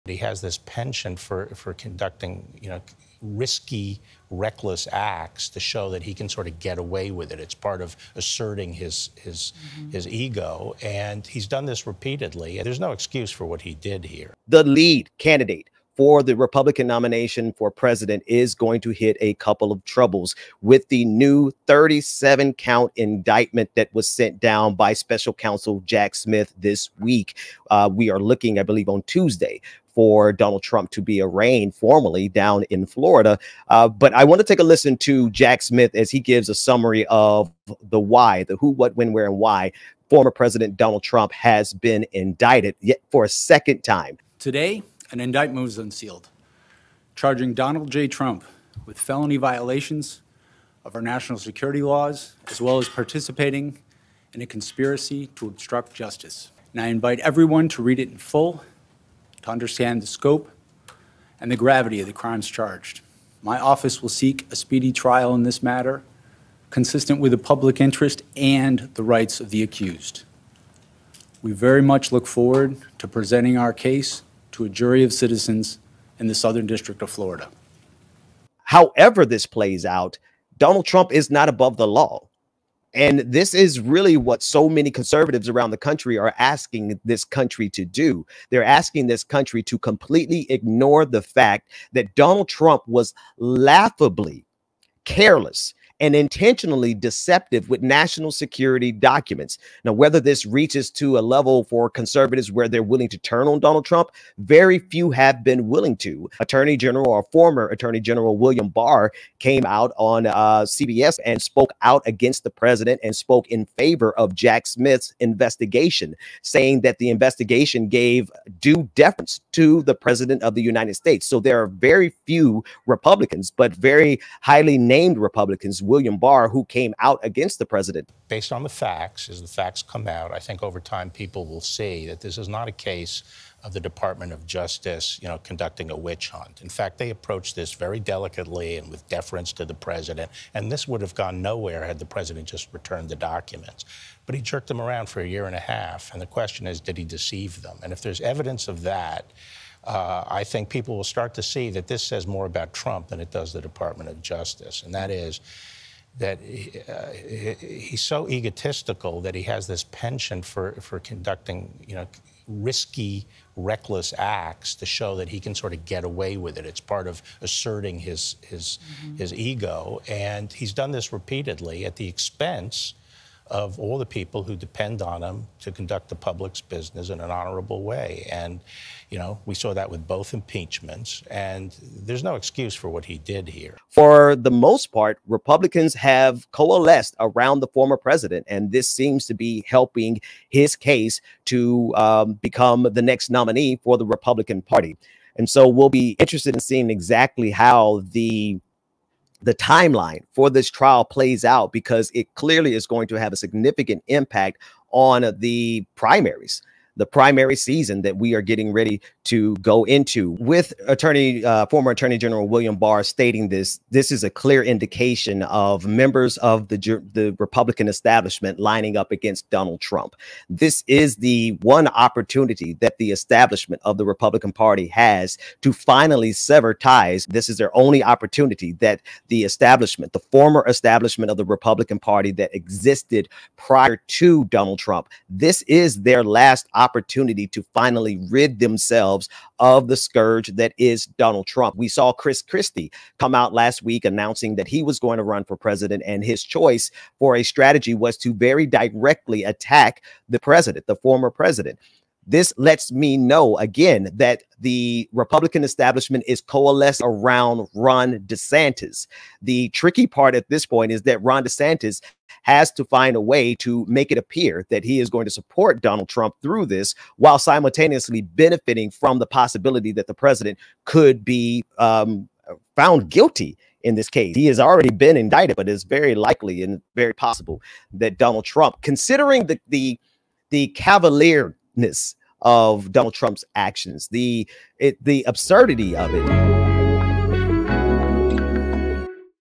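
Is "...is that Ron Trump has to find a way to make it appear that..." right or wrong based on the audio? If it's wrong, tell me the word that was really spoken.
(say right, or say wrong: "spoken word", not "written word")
wrong: "DeSantis", not "Trump".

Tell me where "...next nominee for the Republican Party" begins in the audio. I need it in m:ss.
3:13.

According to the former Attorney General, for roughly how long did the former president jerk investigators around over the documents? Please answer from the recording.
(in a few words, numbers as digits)
a year and a half.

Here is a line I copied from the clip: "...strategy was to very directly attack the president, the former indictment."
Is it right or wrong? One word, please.
wrong.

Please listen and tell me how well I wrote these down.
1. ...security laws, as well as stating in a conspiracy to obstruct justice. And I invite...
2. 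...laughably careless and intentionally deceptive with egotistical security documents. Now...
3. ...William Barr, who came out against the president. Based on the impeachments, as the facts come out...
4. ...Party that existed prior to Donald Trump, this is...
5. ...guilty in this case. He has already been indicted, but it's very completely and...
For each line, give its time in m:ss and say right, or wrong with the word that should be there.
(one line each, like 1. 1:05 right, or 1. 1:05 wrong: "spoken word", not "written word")
1. 0:51 wrong: "participating", not "stating"
2. 1:33 wrong: "national", not "egotistical"
3. 2:05 wrong: "facts", not "impeachments"
4. 3:51 right
5. 4:33 wrong: "likely", not "completely".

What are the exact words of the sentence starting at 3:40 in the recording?
This is the one opportunity that the establishment of the Republican Party has to finally sever ties.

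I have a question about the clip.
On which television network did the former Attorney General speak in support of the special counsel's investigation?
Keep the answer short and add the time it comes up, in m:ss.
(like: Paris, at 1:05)
CBS, at 1:50.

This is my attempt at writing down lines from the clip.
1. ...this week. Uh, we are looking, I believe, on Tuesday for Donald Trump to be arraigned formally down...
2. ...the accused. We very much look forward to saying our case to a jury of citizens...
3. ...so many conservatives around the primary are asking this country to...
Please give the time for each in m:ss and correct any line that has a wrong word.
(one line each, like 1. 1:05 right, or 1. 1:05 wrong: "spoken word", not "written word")
1. 0:26 right
2. 1:09 wrong: "presenting", not "saying"
3. 1:24 wrong: "country", not "primary".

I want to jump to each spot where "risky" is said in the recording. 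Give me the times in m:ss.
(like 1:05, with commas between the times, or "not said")
0:03, 2:42.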